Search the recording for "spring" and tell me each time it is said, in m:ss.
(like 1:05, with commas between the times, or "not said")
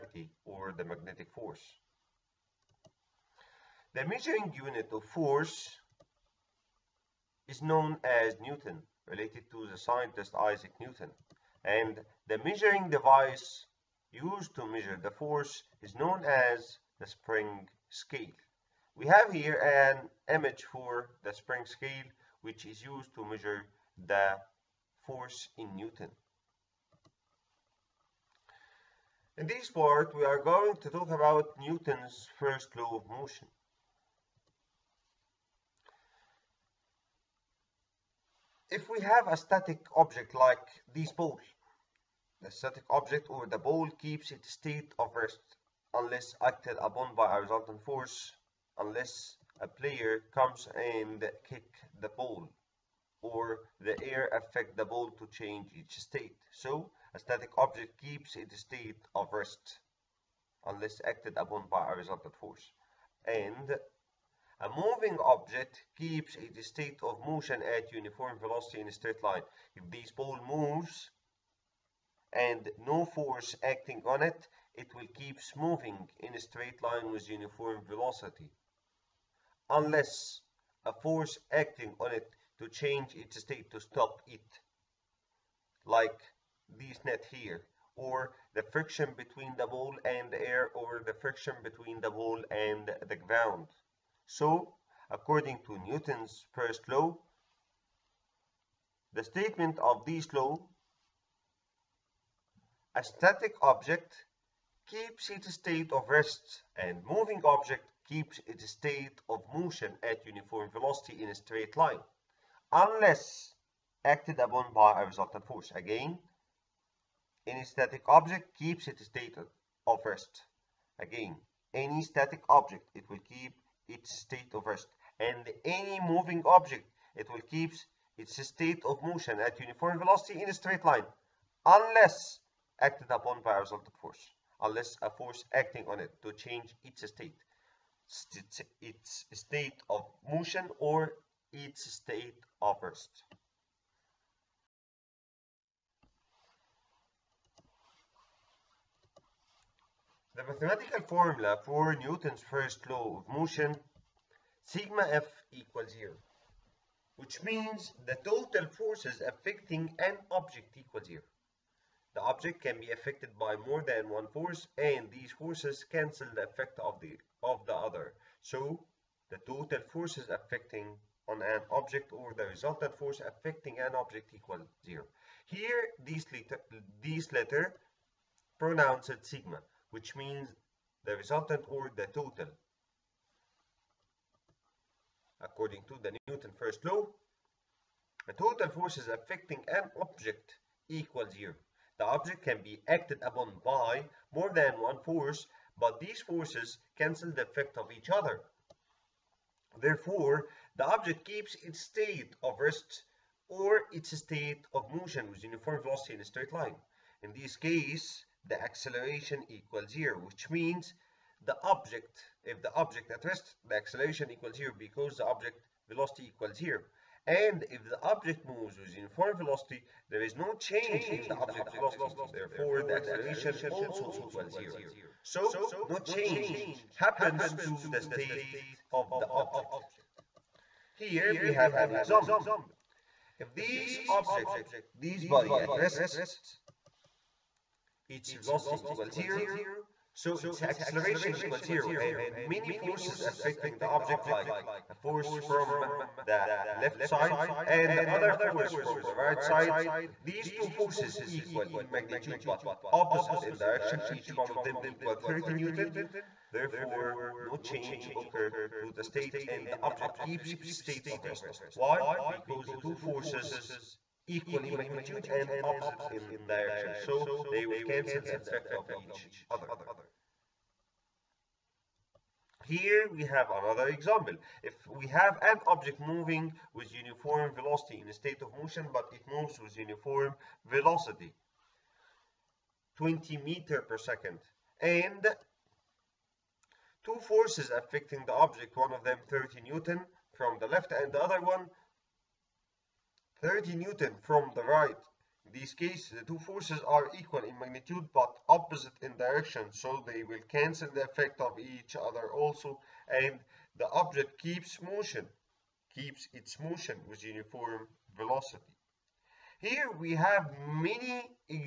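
0:17, 0:21.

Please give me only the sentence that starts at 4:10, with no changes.
These two forces equal in magnitude but opposite in direction, each one of them equal 30 Newton.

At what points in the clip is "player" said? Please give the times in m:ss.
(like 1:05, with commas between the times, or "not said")
0:49.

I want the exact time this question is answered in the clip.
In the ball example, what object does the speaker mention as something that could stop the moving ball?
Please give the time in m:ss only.
1:27.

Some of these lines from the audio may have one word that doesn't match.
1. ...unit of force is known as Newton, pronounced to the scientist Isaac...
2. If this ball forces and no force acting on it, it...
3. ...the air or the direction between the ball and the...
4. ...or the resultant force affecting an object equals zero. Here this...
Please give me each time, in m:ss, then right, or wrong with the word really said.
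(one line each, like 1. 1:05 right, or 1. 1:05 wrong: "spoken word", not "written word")
1. 0:04 wrong: "related", not "pronounced"
2. 1:09 wrong: "moves", not "forces"
3. 1:30 wrong: "friction", not "direction"
4. 2:52 right.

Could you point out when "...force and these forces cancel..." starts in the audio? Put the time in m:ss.
2:44.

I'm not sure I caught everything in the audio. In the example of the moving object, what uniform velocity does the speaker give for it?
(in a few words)
20 meters per second.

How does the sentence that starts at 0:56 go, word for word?
So, a static object keeps its state of rest unless acted upon by a resultant force.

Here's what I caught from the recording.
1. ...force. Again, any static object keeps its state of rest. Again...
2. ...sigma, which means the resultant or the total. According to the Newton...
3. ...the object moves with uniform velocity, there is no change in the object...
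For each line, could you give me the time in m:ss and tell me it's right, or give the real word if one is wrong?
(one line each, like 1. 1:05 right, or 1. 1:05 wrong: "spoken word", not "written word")
1. 1:55 right
2. 2:59 right
3. 3:37 right.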